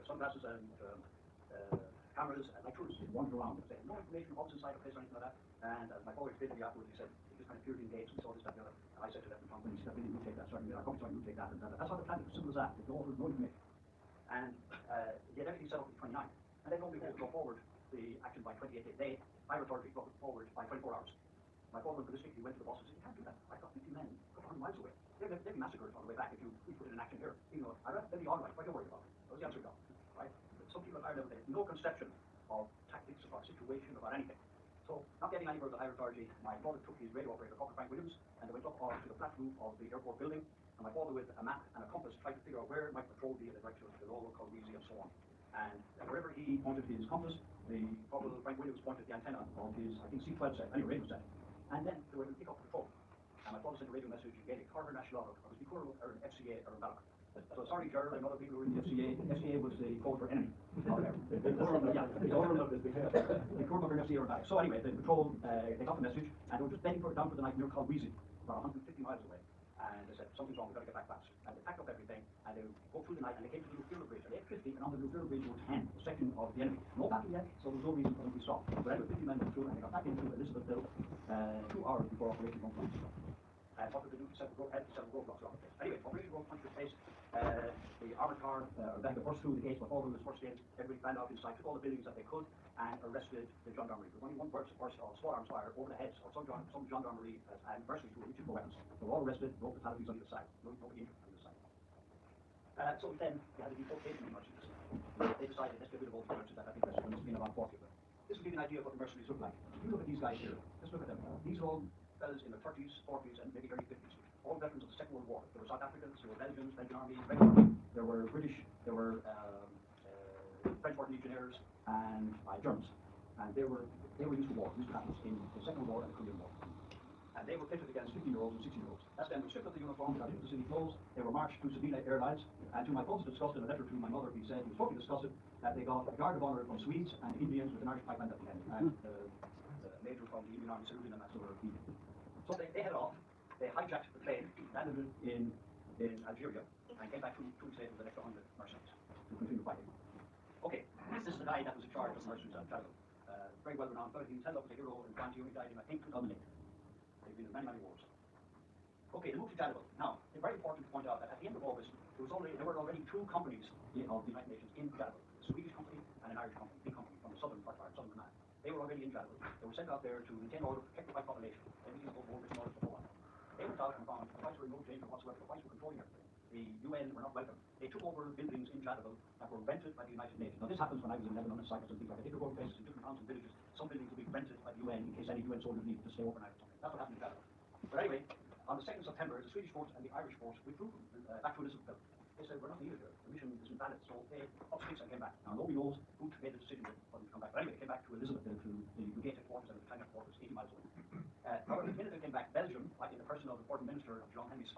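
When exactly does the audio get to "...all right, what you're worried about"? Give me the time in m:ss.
0:28.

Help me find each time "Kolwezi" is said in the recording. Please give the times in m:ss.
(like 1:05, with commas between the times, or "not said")
0:44, 1:07.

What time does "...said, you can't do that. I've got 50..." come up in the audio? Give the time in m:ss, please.
0:22.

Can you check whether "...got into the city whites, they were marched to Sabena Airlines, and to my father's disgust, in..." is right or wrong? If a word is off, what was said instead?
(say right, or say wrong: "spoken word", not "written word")
wrong: "clothes", not "whites".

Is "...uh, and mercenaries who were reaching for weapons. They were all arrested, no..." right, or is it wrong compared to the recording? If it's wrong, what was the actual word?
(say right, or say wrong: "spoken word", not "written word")
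right.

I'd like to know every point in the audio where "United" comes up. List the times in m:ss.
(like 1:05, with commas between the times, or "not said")
2:44, 3:00.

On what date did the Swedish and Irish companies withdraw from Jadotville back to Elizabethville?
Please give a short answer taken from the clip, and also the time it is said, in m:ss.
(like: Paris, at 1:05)
2nd September, at 3:08.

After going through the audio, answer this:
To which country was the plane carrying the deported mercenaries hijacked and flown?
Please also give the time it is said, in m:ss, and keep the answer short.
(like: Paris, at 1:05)
Algeria, at 2:26.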